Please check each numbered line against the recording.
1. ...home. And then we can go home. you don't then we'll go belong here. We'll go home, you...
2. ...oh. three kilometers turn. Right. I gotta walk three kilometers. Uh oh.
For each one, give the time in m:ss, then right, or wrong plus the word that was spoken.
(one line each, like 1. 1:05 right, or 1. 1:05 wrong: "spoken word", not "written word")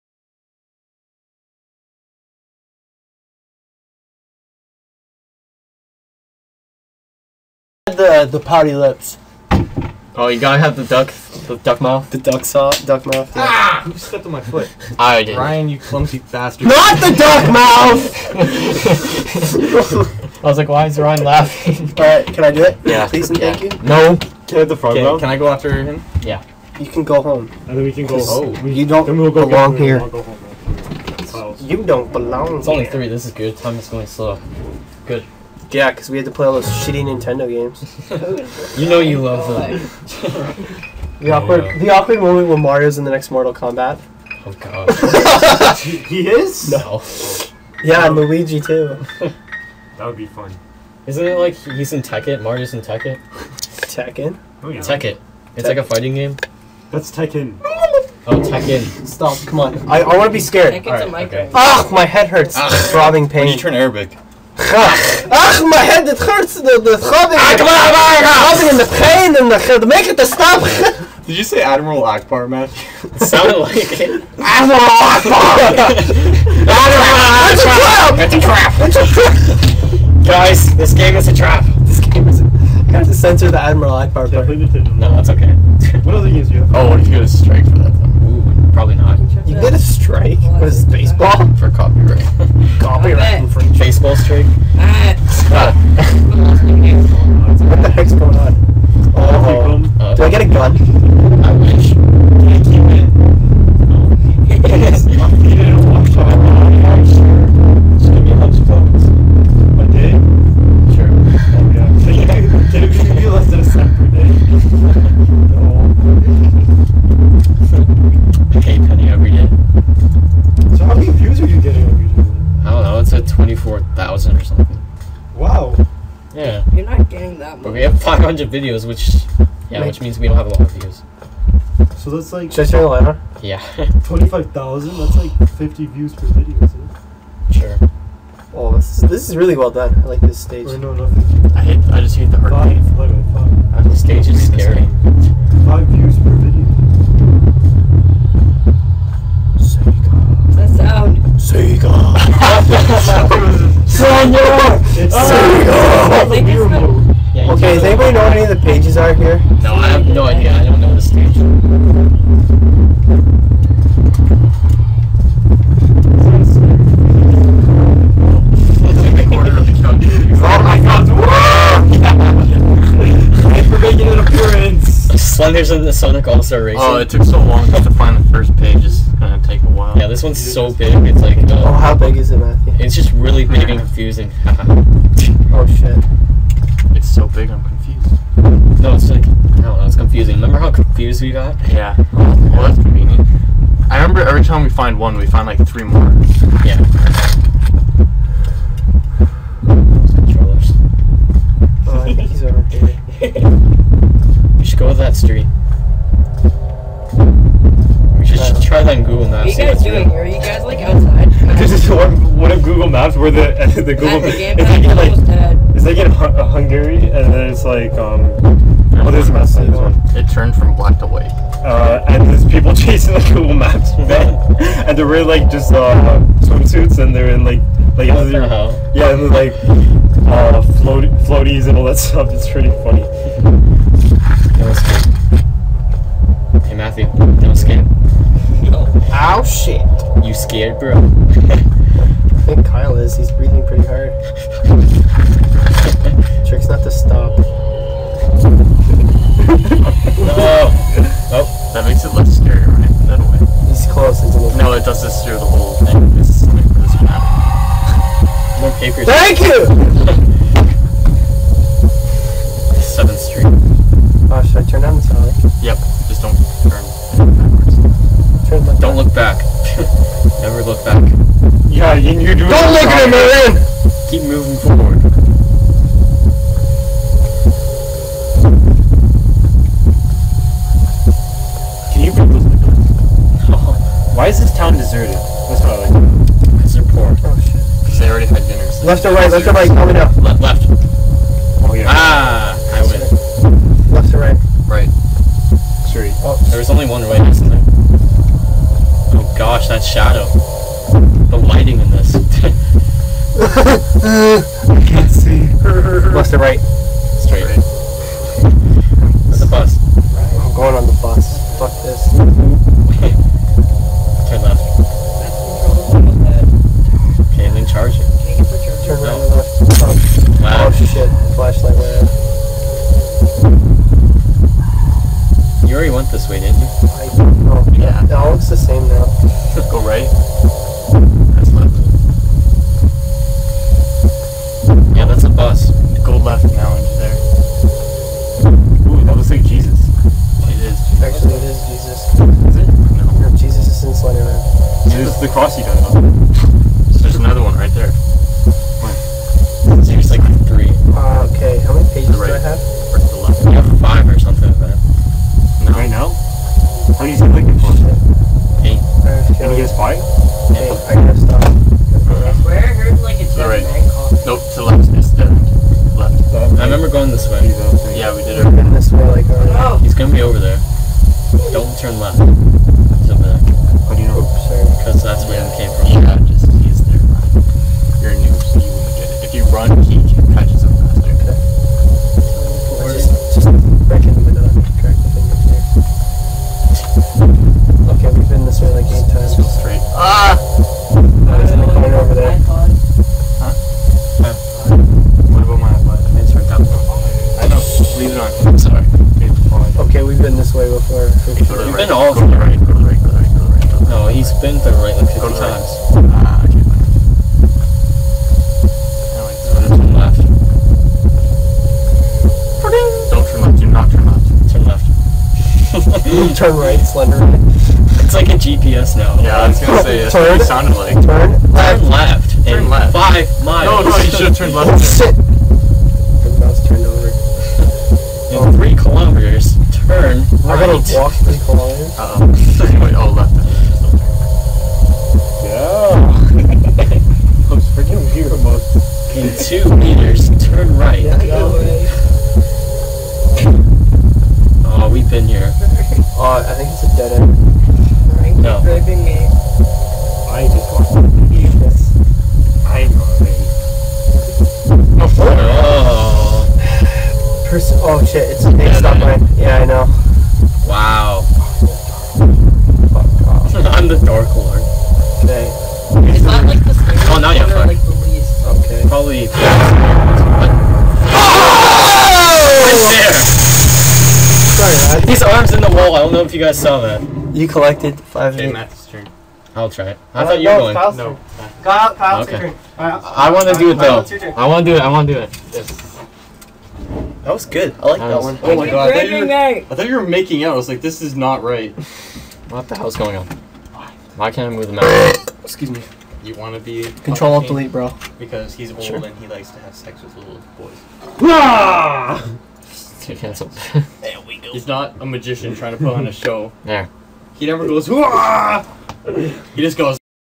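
1. 0:27 right
2. 7:08 right.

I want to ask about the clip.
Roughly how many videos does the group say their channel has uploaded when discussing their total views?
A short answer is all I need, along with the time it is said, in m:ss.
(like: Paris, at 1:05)
500, at 2:08.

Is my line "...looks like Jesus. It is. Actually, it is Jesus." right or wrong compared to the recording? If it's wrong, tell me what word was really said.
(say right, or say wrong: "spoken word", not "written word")
right.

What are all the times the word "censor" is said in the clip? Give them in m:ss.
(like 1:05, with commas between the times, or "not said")
1:23.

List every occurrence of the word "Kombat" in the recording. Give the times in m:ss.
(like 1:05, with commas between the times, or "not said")
0:43.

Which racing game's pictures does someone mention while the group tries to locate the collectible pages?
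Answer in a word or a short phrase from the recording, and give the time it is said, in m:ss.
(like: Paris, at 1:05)
Sonic All Star Racing, at 2:55.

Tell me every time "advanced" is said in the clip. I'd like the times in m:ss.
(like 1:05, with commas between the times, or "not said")
not said.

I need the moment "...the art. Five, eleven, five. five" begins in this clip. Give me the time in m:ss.
2:22.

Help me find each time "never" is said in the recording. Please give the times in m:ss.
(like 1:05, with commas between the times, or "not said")
4:30, 8:27.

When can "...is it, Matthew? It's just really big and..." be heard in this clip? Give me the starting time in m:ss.
3:02.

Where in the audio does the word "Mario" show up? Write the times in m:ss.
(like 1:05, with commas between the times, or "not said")
0:42, 0:52.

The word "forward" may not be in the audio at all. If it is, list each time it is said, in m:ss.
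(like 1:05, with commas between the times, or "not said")
4:34.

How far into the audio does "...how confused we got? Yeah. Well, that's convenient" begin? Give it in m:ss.
3:10.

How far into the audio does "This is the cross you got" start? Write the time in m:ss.
5:44.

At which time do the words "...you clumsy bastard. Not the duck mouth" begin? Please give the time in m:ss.
0:15.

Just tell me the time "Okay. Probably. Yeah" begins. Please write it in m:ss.
7:48.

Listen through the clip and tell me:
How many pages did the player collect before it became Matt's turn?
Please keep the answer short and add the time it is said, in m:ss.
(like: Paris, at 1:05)
5, at 7:57.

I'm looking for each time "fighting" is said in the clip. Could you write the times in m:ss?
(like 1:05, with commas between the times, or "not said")
0:55.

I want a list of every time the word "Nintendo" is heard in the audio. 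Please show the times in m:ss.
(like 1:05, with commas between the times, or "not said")
0:37.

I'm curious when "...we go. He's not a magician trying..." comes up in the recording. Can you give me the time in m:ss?
8:24.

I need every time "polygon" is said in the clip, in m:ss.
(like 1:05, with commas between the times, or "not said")
not said.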